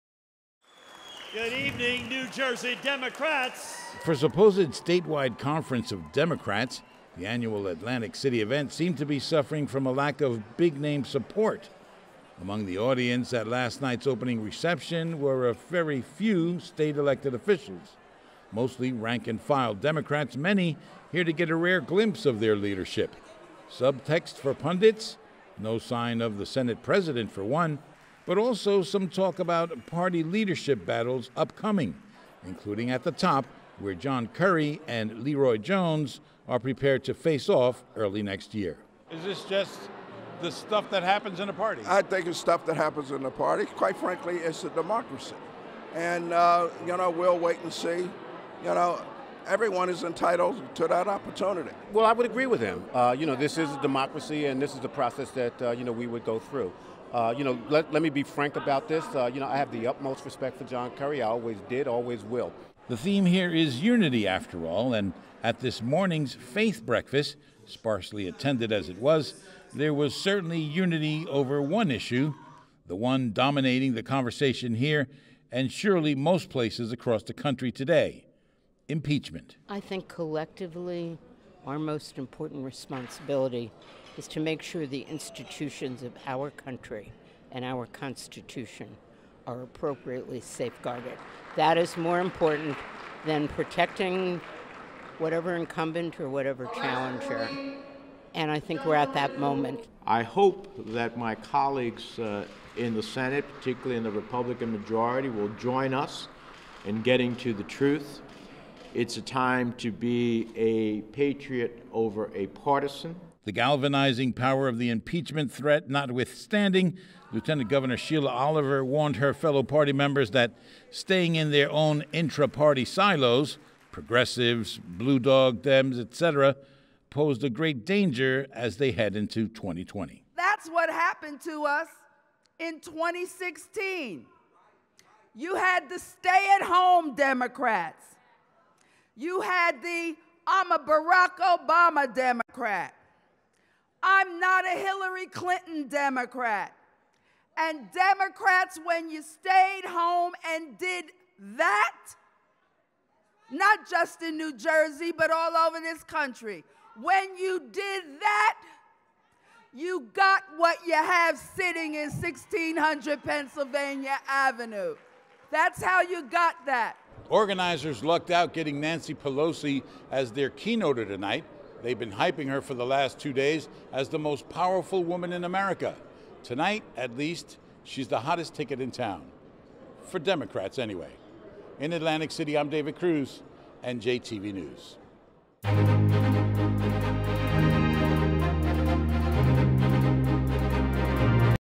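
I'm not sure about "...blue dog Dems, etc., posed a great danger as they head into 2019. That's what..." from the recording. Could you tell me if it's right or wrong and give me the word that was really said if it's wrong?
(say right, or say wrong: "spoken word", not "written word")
wrong: "2020", not "2019".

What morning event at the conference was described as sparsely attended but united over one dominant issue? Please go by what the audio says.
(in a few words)
faith breakfast.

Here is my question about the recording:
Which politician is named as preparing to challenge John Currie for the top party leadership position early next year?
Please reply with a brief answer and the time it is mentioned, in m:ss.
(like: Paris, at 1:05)
Leroy Jones, at 0:35.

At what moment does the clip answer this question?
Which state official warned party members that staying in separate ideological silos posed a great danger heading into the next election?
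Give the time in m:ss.
1:57.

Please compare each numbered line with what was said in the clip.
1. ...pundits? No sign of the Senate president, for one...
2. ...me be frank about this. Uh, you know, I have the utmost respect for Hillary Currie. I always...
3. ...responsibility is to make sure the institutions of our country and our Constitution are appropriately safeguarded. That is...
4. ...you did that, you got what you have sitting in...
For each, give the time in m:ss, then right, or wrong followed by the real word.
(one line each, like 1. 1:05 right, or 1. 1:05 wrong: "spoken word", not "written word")
1. 0:24 right
2. 0:58 wrong: "John", not "Hillary"
3. 1:22 right
4. 2:37 right.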